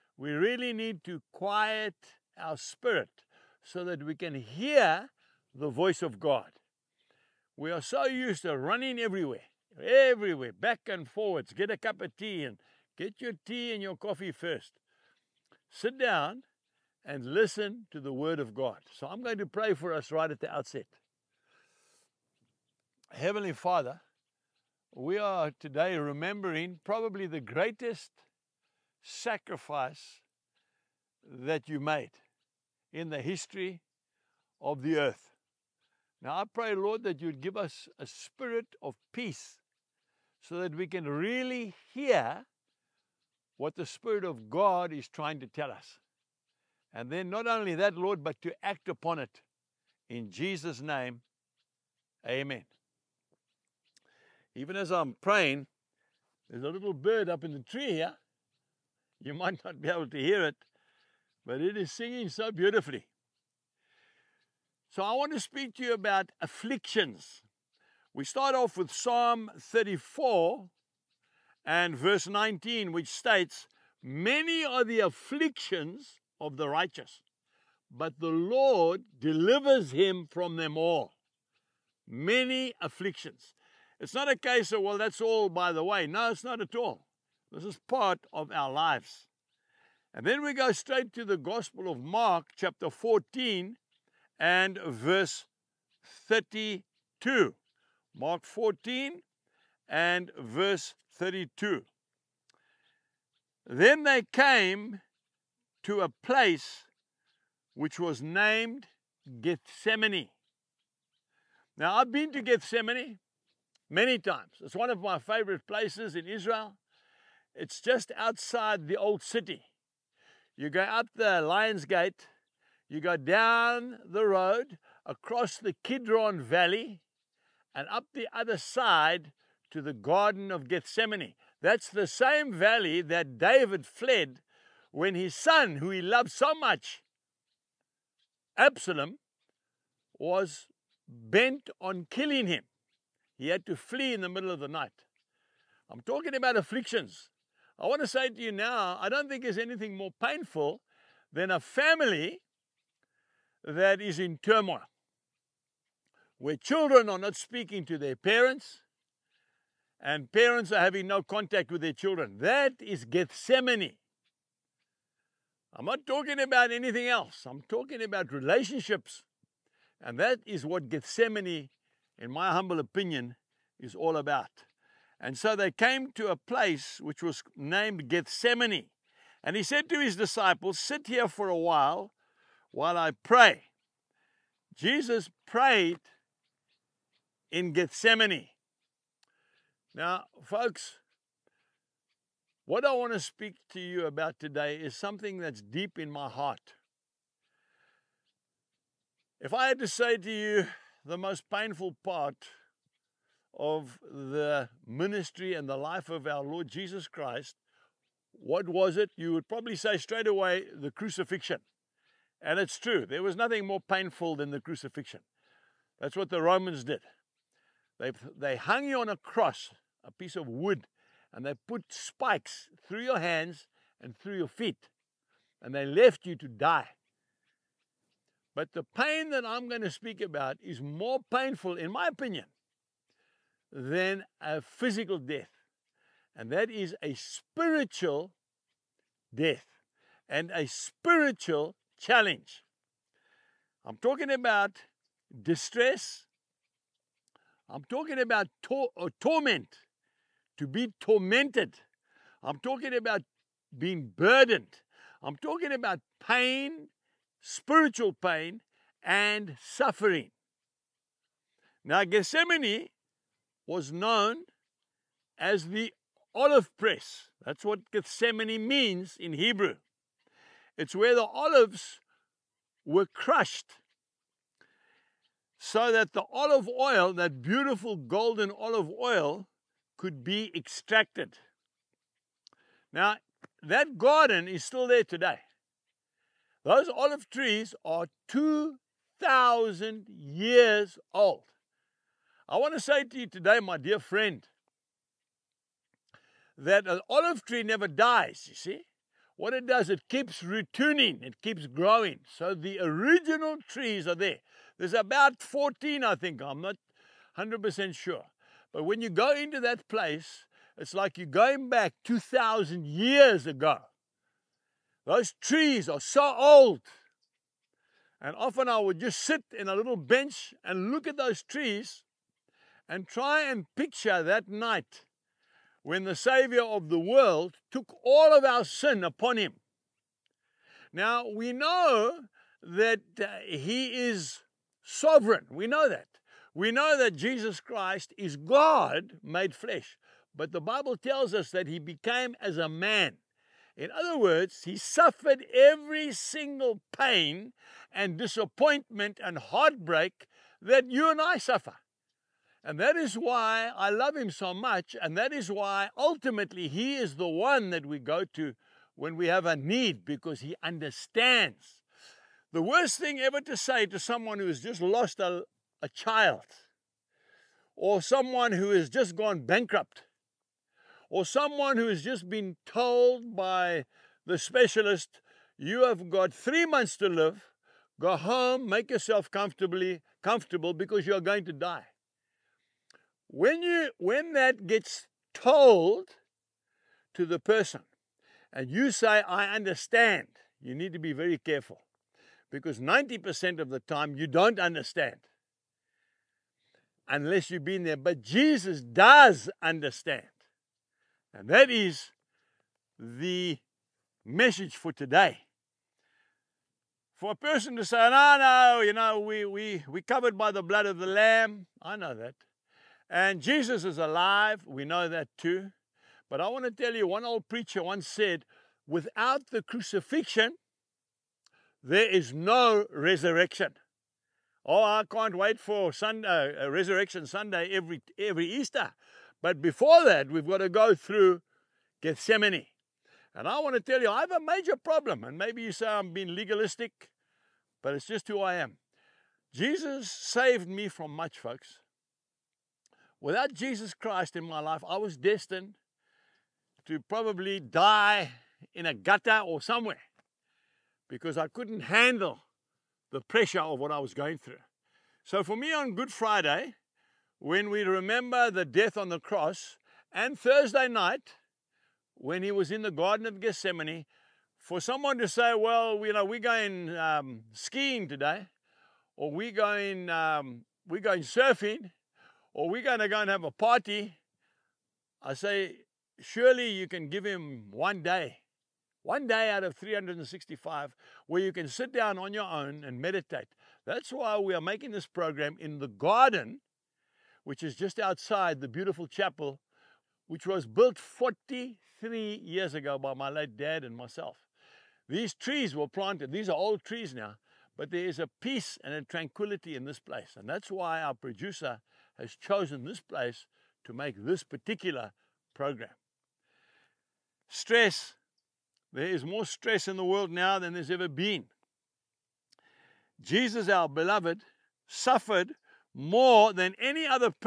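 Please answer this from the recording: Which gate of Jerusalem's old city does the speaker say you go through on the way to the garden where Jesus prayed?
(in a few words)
Lions Gate.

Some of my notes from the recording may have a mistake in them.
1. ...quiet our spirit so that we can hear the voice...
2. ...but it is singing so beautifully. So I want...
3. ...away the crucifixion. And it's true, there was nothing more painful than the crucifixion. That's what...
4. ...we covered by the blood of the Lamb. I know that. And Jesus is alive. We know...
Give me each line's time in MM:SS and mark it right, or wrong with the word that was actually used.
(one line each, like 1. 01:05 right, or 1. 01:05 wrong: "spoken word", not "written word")
1. 00:01 right
2. 01:01 right
3. 03:30 right
4. 06:49 right.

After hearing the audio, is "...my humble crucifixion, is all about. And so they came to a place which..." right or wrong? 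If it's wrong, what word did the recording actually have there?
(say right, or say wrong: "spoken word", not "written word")
wrong: "opinion", not "crucifixion".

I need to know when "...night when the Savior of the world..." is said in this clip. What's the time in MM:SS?
05:24.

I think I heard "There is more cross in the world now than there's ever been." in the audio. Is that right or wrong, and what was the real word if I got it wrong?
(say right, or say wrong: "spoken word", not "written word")
wrong: "stress", not "cross".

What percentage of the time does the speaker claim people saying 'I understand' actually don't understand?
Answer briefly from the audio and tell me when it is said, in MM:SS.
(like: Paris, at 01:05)
90%, at 06:32.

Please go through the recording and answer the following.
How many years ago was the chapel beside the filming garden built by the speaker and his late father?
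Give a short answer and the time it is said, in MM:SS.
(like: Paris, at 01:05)
43, at 08:10.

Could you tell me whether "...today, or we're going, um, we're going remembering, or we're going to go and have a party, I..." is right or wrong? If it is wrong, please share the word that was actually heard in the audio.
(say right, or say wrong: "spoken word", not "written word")
wrong: "surfing", not "remembering".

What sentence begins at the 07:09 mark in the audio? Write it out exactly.
But before that, we've got to go through Gethsemane.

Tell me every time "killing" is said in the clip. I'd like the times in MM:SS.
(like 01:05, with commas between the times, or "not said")
02:22.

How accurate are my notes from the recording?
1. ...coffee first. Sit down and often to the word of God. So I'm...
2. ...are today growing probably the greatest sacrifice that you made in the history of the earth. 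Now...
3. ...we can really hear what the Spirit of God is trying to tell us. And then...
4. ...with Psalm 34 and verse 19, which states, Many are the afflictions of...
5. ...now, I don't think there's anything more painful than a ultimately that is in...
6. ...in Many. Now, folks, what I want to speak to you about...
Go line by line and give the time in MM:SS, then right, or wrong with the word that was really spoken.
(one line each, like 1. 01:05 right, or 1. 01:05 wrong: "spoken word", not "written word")
1. 00:13 wrong: "listen", not "often"
2. 00:25 wrong: "remembering", not "growing"
3. 00:40 right
4. 01:08 right
5. 02:28 wrong: "family", not "ultimately"
6. 03:07 wrong: "Gethsemane", not "Many".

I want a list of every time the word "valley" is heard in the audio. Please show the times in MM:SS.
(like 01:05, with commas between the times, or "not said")
02:06, 02:12.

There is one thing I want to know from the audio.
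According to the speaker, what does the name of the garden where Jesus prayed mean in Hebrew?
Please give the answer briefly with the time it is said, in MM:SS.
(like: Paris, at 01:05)
The olive press, at 04:25.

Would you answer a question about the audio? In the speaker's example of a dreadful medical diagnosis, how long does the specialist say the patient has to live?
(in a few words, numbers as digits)
Three months.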